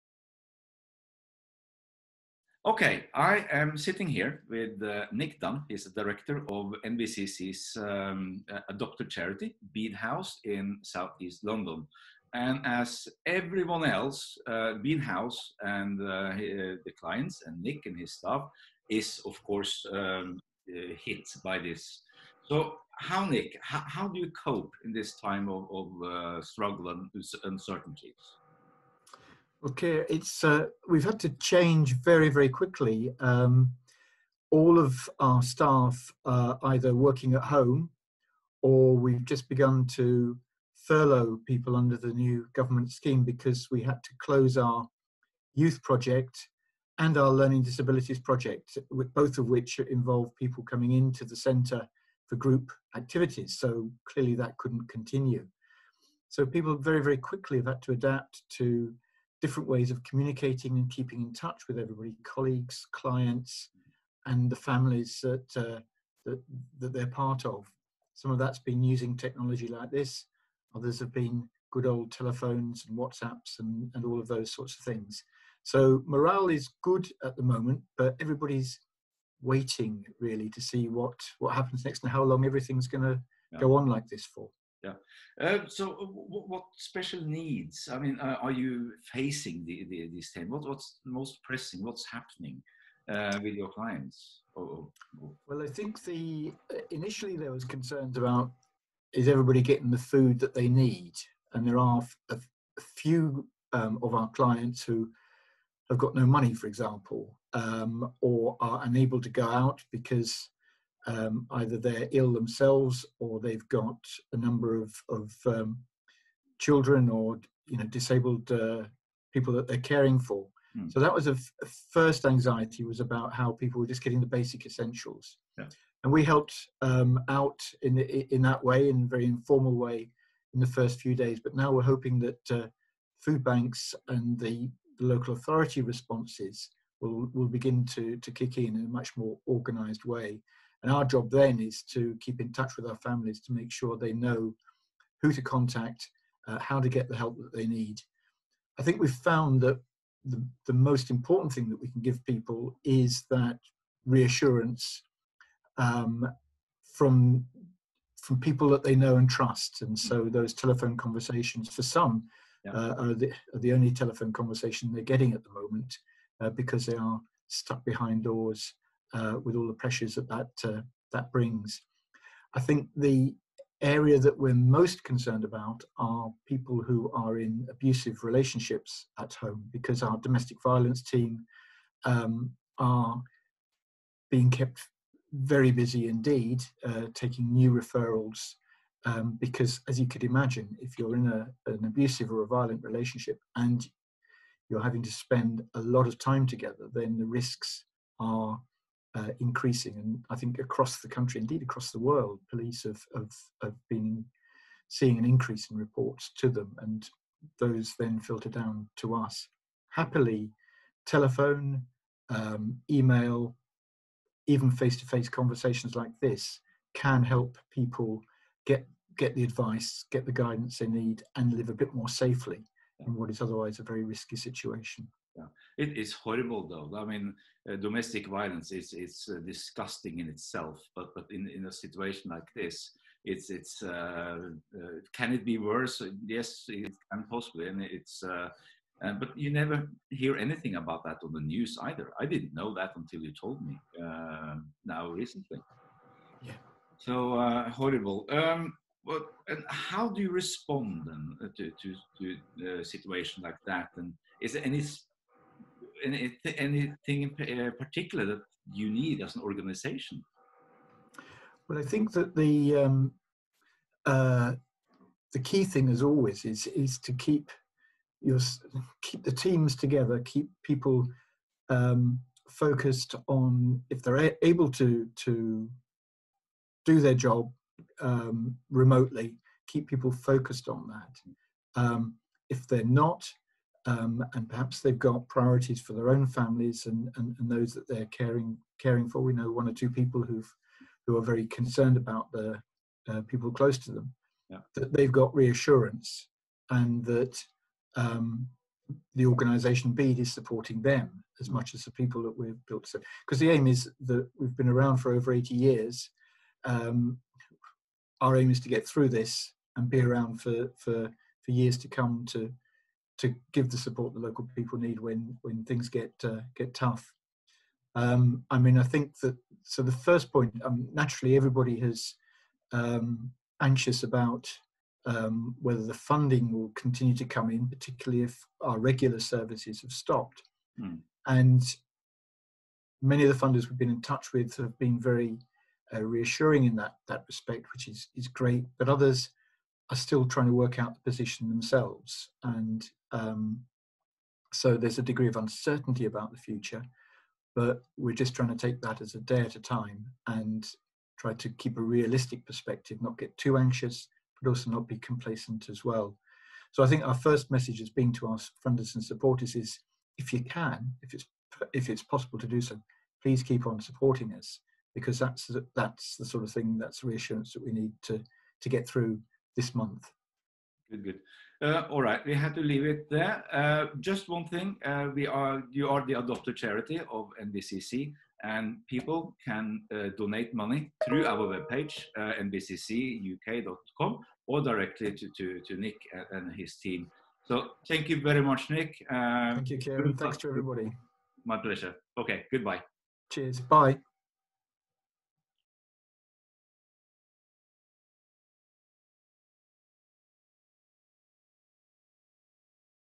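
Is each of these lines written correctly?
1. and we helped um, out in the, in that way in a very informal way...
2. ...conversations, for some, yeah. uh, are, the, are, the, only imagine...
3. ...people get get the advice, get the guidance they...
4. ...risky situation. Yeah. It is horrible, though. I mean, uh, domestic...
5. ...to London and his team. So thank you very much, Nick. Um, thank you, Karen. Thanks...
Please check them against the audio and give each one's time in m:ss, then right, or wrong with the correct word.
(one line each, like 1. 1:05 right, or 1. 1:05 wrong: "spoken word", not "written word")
1. 2:06 right
2. 2:40 wrong: "telephone", not "imagine"
3. 3:37 right
4. 3:44 right
5. 6:25 wrong: "Nick", not "London".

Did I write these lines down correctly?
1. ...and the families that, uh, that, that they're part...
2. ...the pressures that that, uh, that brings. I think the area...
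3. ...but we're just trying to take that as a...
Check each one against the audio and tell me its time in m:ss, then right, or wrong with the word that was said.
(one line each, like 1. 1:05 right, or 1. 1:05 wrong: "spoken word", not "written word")
1. 1:04 right
2. 2:49 right
3. 5:47 right.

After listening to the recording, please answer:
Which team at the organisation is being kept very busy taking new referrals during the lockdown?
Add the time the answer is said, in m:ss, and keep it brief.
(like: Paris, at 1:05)
domestic violence team, at 3:00.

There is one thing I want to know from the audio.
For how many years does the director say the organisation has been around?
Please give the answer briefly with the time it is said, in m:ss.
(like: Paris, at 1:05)
over 80 years, at 5:05.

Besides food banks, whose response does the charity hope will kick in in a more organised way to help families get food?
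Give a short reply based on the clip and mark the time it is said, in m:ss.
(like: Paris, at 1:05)
local authority, at 2:15.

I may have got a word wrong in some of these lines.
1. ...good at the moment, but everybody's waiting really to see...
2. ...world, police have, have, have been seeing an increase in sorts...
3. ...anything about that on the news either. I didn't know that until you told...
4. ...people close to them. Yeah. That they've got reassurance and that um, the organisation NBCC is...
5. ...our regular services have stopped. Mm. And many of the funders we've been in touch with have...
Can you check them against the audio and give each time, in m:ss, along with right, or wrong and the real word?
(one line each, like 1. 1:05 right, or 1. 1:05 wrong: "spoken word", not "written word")
1. 1:16 right
2. 3:21 wrong: "reports", not "sorts"
3. 4:00 right
4. 4:53 wrong: "Bede", not "NBCC"
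5. 5:28 right.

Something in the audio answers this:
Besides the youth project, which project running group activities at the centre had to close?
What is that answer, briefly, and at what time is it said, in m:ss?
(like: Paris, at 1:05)
learning disabilities project, at 0:47.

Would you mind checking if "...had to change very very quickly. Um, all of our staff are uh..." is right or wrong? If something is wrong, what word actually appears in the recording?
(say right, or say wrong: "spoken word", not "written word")
right.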